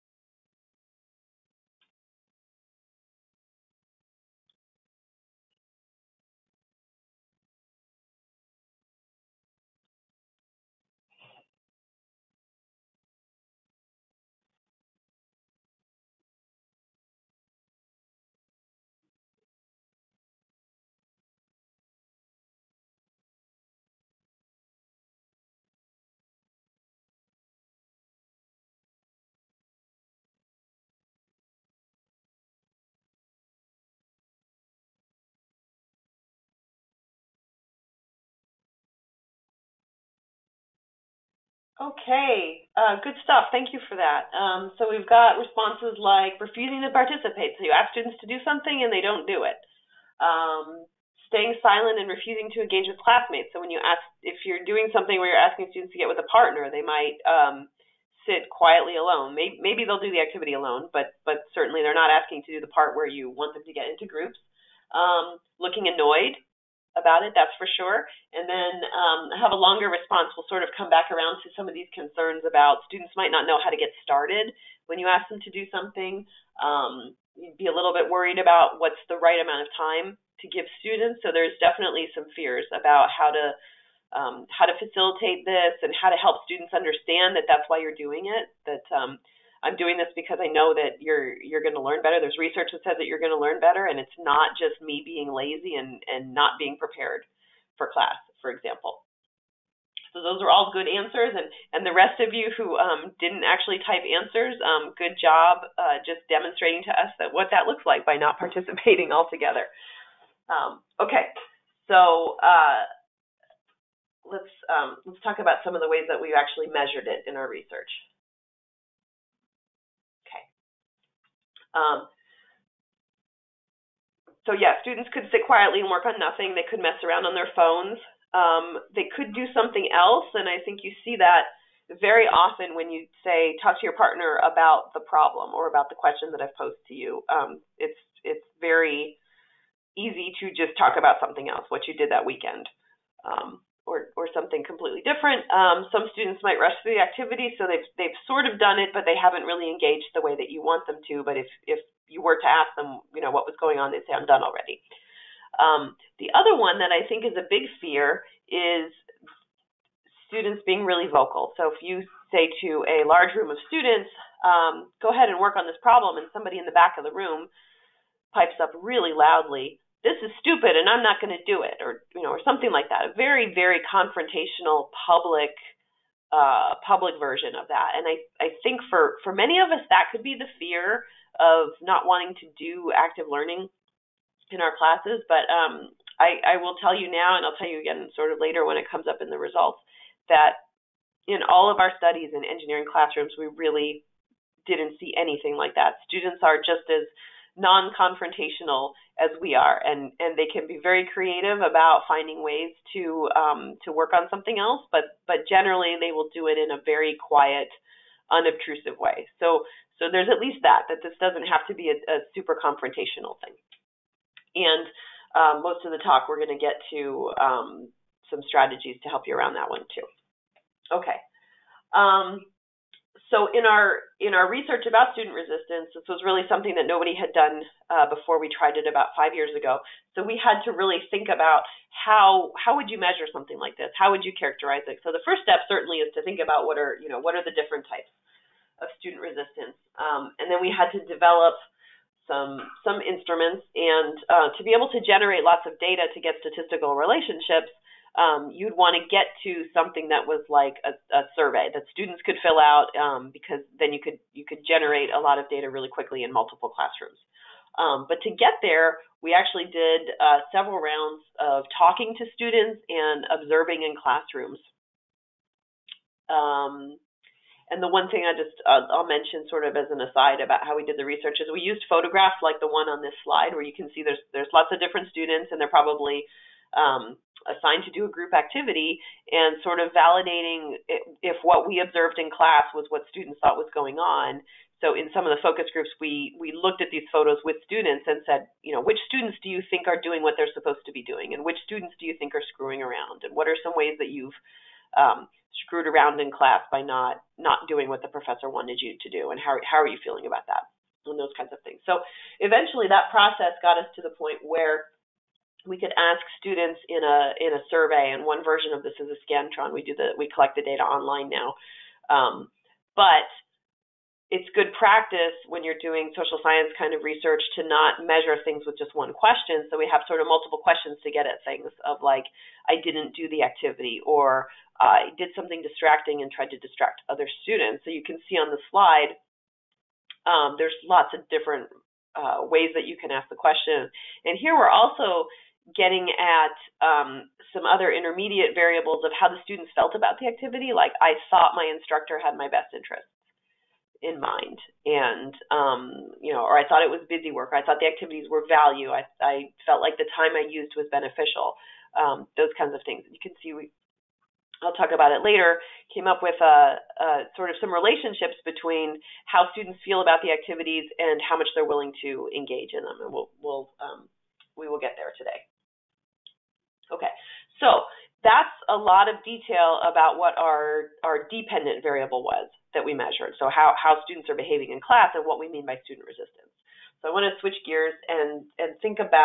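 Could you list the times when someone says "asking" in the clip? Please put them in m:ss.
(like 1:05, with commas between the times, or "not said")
0:55, 1:02.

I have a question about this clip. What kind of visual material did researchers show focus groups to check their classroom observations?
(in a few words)
Photographs.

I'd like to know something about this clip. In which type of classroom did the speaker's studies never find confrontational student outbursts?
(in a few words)
Engineering classrooms.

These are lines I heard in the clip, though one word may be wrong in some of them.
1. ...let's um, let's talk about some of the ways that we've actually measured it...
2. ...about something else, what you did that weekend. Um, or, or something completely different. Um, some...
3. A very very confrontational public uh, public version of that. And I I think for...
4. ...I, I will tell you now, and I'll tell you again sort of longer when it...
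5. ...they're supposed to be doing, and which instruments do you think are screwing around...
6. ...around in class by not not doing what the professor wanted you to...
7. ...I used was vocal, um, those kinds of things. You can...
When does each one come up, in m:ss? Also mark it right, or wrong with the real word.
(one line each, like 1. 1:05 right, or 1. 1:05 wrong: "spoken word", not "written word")
1. 1:54 right
2. 2:20 right
3. 2:53 right
4. 3:06 wrong: "later", not "longer"
5. 4:50 wrong: "students", not "instruments"
6. 4:55 right
7. 5:50 wrong: "beneficial", not "vocal".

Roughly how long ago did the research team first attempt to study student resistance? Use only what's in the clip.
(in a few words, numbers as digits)
About 5 years ago.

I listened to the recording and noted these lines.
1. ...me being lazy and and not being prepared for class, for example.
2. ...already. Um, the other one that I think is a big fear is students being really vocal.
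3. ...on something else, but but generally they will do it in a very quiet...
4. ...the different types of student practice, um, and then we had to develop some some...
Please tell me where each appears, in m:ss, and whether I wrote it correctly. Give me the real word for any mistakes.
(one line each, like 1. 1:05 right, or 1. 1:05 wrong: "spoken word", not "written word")
1. 1:34 right
2. 2:34 right
3. 3:24 right
4. 3:57 wrong: "resistance", not "practice".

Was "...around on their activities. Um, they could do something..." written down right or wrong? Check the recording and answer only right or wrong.
wrong.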